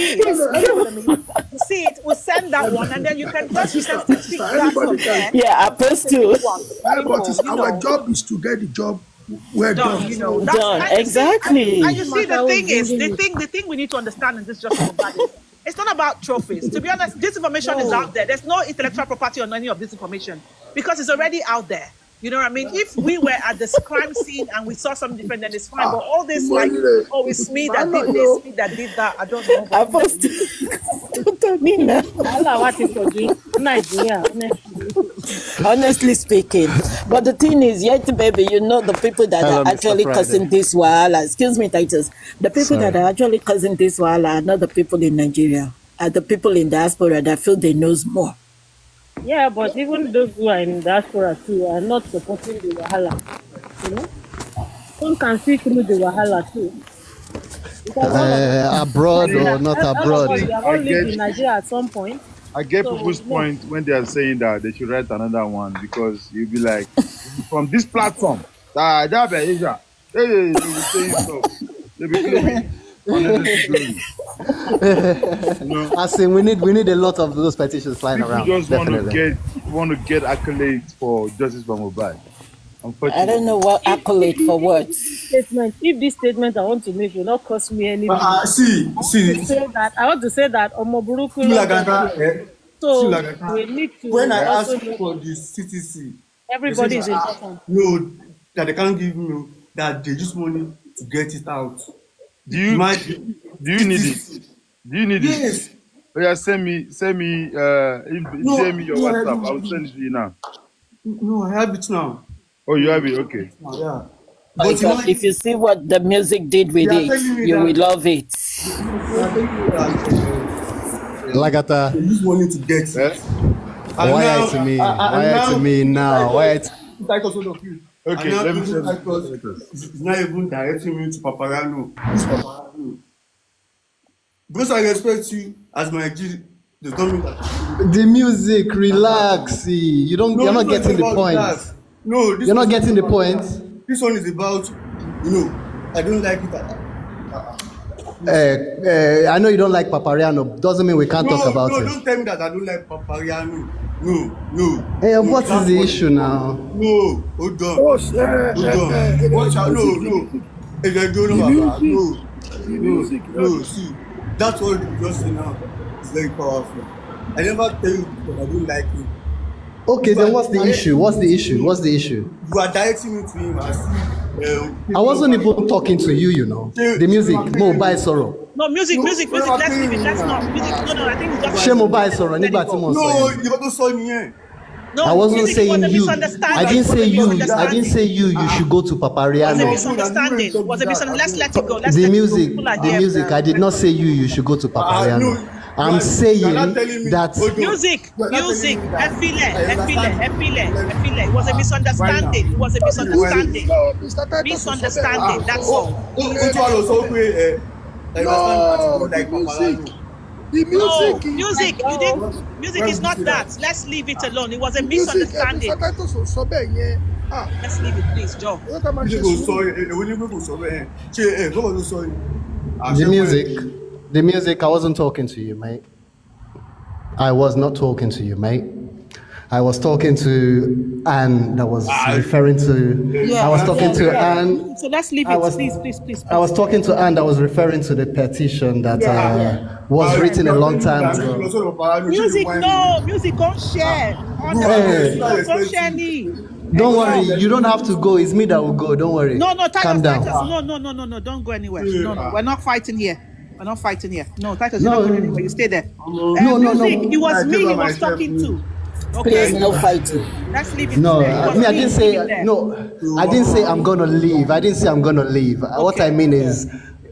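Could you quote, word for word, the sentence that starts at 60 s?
Us, I get, in Nigeria at some point.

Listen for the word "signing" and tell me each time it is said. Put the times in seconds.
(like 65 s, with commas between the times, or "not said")
not said.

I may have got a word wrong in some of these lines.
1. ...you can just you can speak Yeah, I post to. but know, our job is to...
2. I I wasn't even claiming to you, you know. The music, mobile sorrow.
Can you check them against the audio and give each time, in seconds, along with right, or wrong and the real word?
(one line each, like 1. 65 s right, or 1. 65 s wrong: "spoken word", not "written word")
1. 3 s right
2. 173 s wrong: "talking", not "claiming".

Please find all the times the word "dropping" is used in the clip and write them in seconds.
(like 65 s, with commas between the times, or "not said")
not said.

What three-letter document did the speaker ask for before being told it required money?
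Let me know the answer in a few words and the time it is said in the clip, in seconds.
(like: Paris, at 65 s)
CTC, at 95 s.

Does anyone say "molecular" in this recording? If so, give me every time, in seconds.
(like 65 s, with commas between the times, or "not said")
not said.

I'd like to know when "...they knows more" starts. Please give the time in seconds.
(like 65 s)
47 s.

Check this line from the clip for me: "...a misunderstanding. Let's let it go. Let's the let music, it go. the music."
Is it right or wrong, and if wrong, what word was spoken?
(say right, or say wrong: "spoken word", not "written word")
right.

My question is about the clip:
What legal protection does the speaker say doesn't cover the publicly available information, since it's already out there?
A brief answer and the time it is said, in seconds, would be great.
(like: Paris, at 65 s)
Intellectual property, at 18 s.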